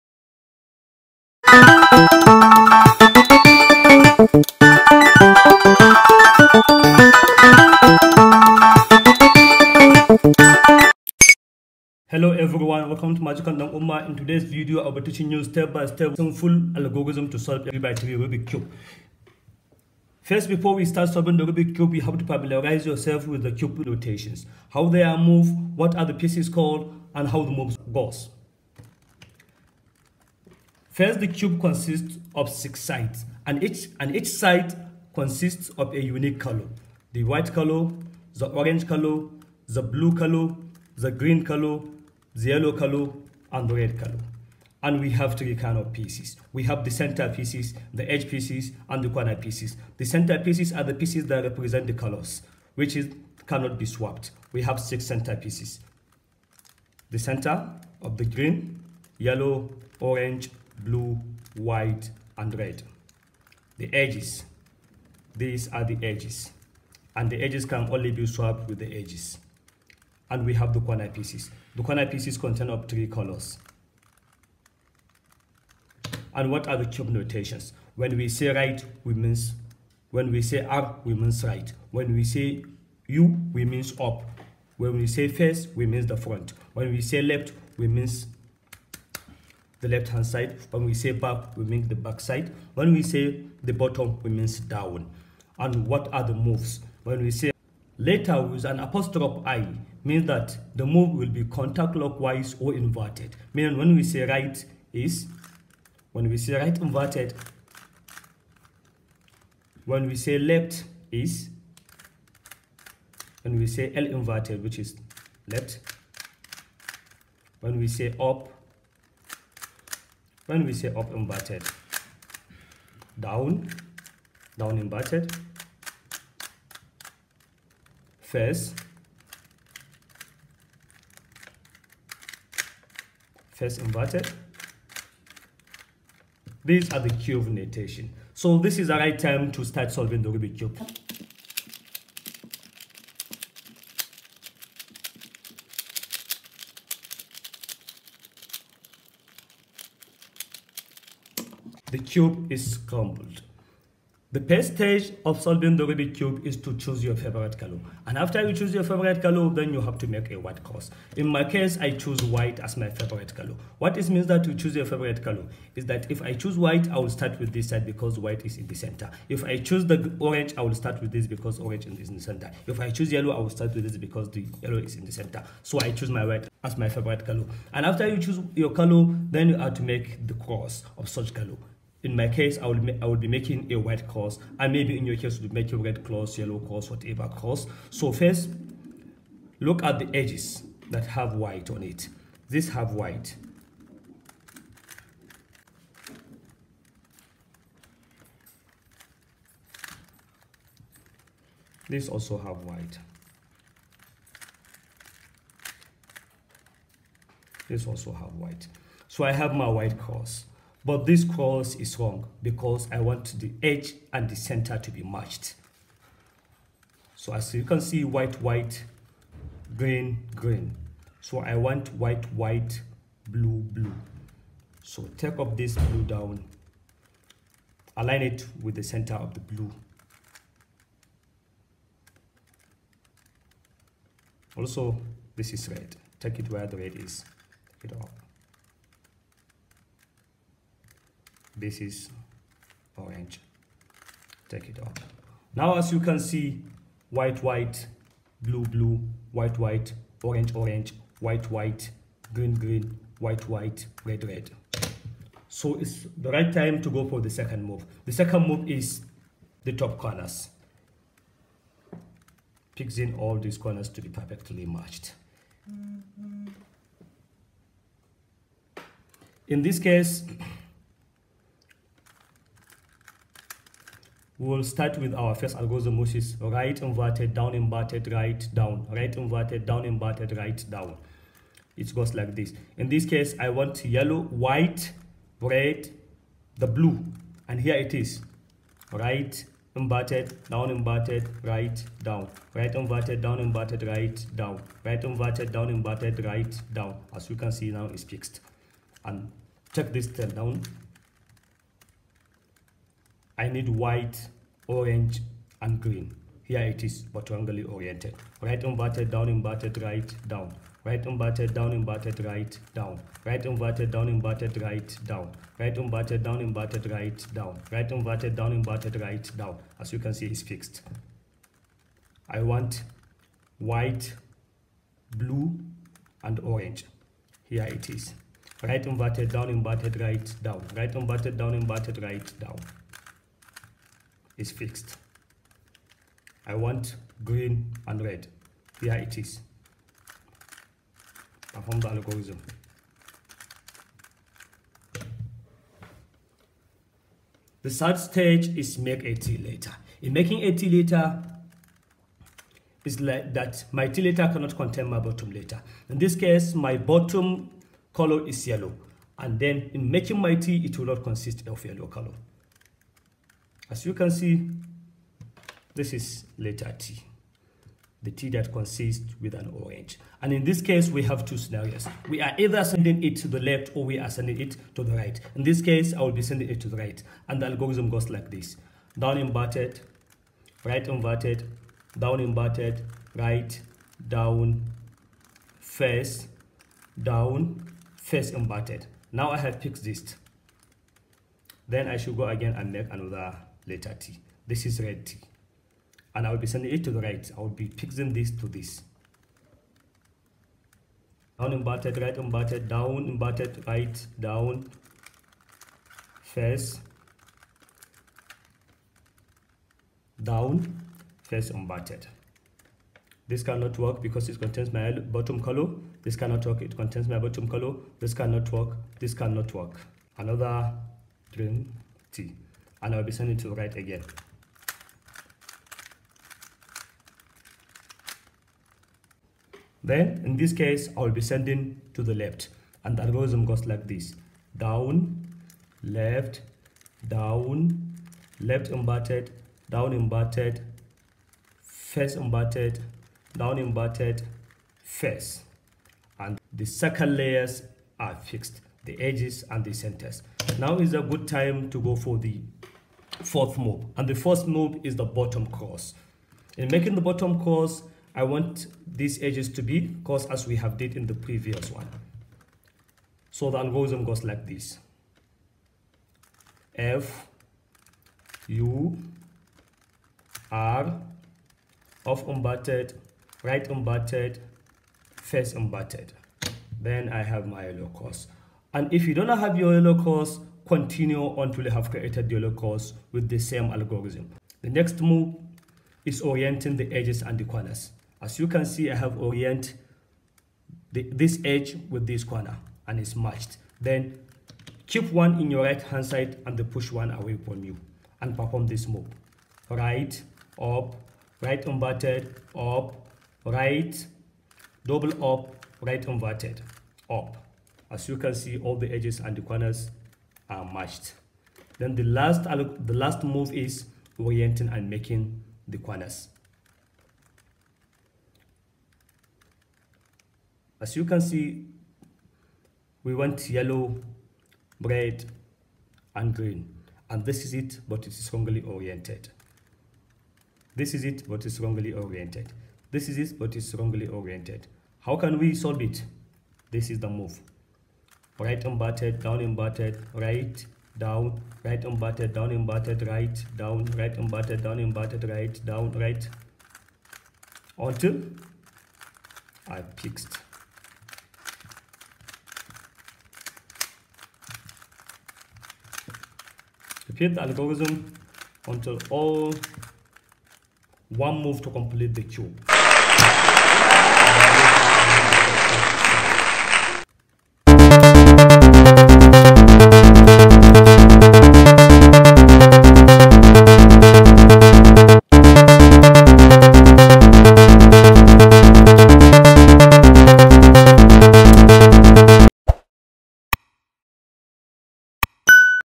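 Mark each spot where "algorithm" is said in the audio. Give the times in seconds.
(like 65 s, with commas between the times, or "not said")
16 s, 275 s, 341 s, 377 s, 433 s, 463 s, 483 s, 557 s.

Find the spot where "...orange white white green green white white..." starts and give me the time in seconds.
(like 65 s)
250 s.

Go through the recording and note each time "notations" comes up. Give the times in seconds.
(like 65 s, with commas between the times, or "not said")
77 s, 137 s.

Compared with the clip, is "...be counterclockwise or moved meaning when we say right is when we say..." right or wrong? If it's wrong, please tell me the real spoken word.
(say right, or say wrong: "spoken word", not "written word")
wrong: "inverted", not "moved".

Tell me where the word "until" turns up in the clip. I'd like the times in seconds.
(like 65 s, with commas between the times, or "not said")
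481 s, 547 s, 558 s.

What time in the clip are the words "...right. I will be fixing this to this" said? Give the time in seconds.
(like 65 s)
397 s.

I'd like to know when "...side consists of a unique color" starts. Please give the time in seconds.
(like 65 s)
34 s.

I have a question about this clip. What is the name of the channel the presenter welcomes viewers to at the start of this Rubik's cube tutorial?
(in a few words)
Magical Dan Umma.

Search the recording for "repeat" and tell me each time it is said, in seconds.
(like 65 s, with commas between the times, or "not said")
557 s.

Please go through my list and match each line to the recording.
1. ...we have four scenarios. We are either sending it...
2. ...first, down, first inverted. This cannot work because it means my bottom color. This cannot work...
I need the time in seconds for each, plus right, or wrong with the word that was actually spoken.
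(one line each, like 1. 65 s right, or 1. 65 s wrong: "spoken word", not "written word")
1. 370 s wrong: "two", not "four"
2. 406 s wrong: "contains", not "means".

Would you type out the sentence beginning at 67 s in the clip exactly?
And the edges can only be swapped with the edges.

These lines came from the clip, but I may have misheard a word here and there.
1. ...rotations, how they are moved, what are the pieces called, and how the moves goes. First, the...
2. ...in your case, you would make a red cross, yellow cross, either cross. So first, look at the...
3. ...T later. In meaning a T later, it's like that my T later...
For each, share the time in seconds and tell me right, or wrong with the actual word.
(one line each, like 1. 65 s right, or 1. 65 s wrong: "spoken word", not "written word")
1. 23 s right
2. 184 s wrong: "whatever", not "either"
3. 349 s wrong: "making", not "meaning".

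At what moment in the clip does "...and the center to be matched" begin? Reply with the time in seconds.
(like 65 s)
214 s.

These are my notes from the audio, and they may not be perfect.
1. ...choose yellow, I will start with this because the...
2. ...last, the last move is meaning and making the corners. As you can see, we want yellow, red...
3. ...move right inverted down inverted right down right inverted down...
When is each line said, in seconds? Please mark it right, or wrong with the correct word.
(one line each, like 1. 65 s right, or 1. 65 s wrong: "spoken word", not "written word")
1. 172 s right
2. 512 s wrong: "orienting", not "meaning"
3. 537 s right.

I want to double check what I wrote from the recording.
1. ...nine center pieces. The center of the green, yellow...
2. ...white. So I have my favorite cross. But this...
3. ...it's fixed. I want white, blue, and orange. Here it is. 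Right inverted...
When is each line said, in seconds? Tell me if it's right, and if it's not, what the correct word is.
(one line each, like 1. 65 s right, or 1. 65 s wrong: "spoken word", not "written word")
1. 54 s wrong: "six", not "nine"
2. 208 s wrong: "white", not "favorite"
3. 320 s right.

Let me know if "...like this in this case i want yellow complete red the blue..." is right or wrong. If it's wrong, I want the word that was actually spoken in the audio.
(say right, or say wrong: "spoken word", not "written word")
wrong: "white", not "complete".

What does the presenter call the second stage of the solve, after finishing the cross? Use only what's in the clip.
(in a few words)
Top corners.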